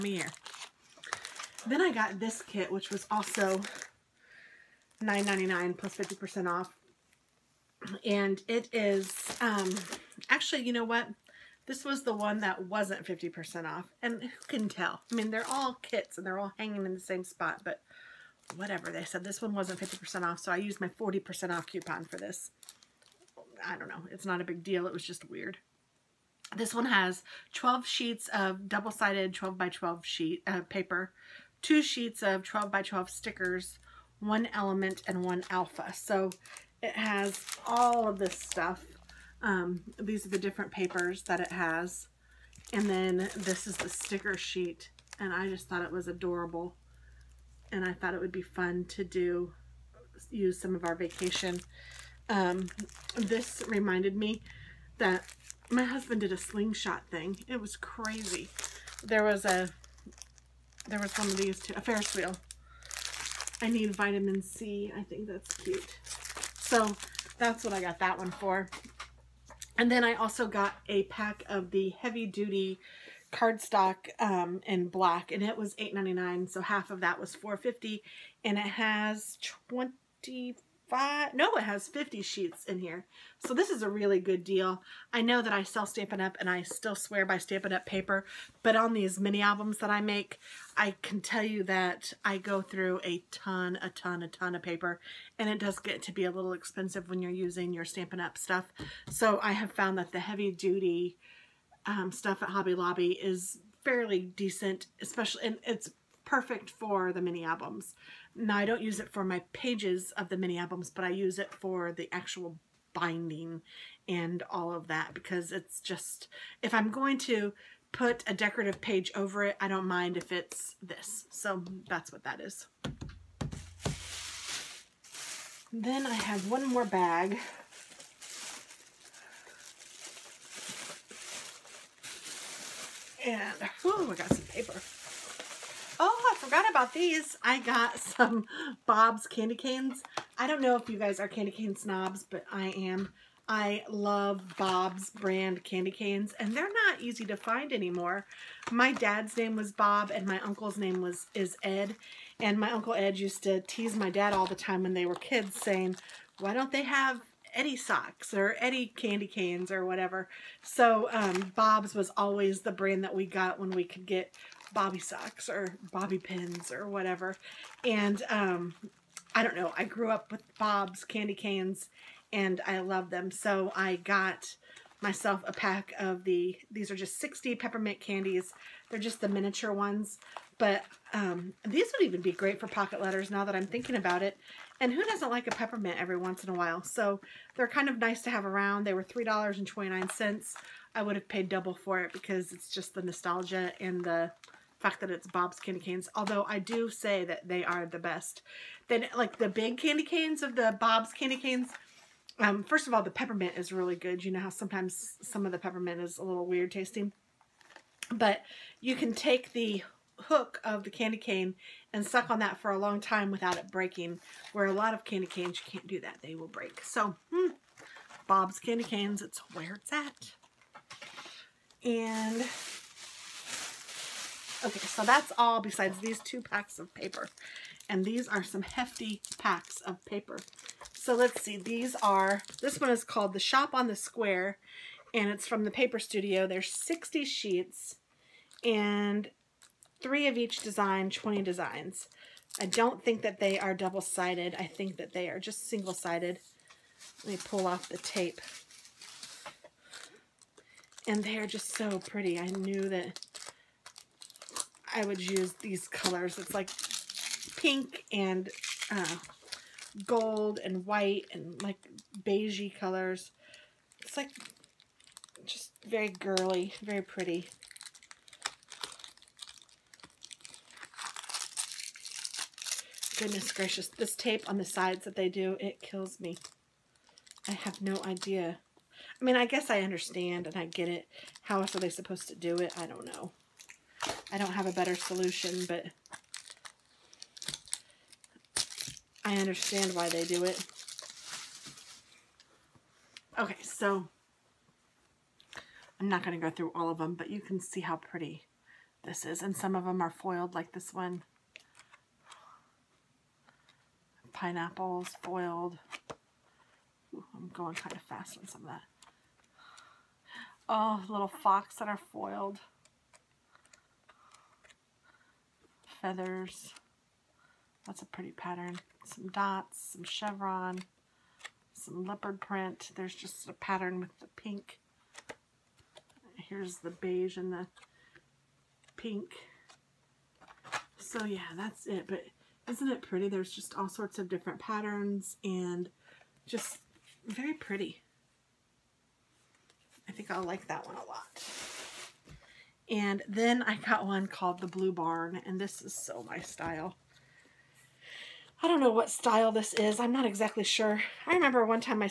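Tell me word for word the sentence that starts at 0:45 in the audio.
And I just thought it was adorable.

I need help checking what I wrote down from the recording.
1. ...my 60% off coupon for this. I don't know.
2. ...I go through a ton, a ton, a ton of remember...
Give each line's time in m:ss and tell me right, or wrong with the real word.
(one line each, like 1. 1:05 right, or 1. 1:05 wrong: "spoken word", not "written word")
1. 0:20 wrong: "40", not "60"
2. 1:32 wrong: "paper", not "remember".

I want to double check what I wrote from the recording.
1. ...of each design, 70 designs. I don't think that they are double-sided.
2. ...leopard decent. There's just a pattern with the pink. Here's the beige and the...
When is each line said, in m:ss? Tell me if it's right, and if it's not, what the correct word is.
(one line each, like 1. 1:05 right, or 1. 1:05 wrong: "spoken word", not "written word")
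1. 4:00 wrong: "20", not "70"
2. 5:22 wrong: "print", not "decent".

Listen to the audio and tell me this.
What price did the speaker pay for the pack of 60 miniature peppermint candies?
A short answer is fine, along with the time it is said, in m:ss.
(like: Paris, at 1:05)
$3.29, at 3:09.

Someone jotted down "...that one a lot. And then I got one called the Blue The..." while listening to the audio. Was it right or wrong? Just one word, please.
wrong.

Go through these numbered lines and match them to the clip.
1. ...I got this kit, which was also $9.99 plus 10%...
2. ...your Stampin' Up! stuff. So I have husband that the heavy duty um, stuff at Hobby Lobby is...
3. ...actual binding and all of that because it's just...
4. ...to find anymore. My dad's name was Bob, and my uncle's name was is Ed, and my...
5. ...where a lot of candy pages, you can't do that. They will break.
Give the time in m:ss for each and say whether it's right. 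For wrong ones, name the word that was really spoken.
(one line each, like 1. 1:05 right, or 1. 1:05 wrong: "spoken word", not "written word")
1. 0:01 wrong: "50", not "10"
2. 1:37 wrong: "found", not "husband"
3. 1:52 right
4. 2:27 right
5. 3:34 wrong: "canes", not "pages".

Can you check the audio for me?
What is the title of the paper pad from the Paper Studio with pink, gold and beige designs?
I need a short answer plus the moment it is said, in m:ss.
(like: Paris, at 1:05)
The Shop on the Square, at 3:53.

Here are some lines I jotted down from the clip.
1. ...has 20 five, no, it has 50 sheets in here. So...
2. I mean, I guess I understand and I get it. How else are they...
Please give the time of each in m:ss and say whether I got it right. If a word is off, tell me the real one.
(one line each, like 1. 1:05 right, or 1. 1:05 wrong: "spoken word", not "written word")
1. 1:18 right
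2. 4:39 right.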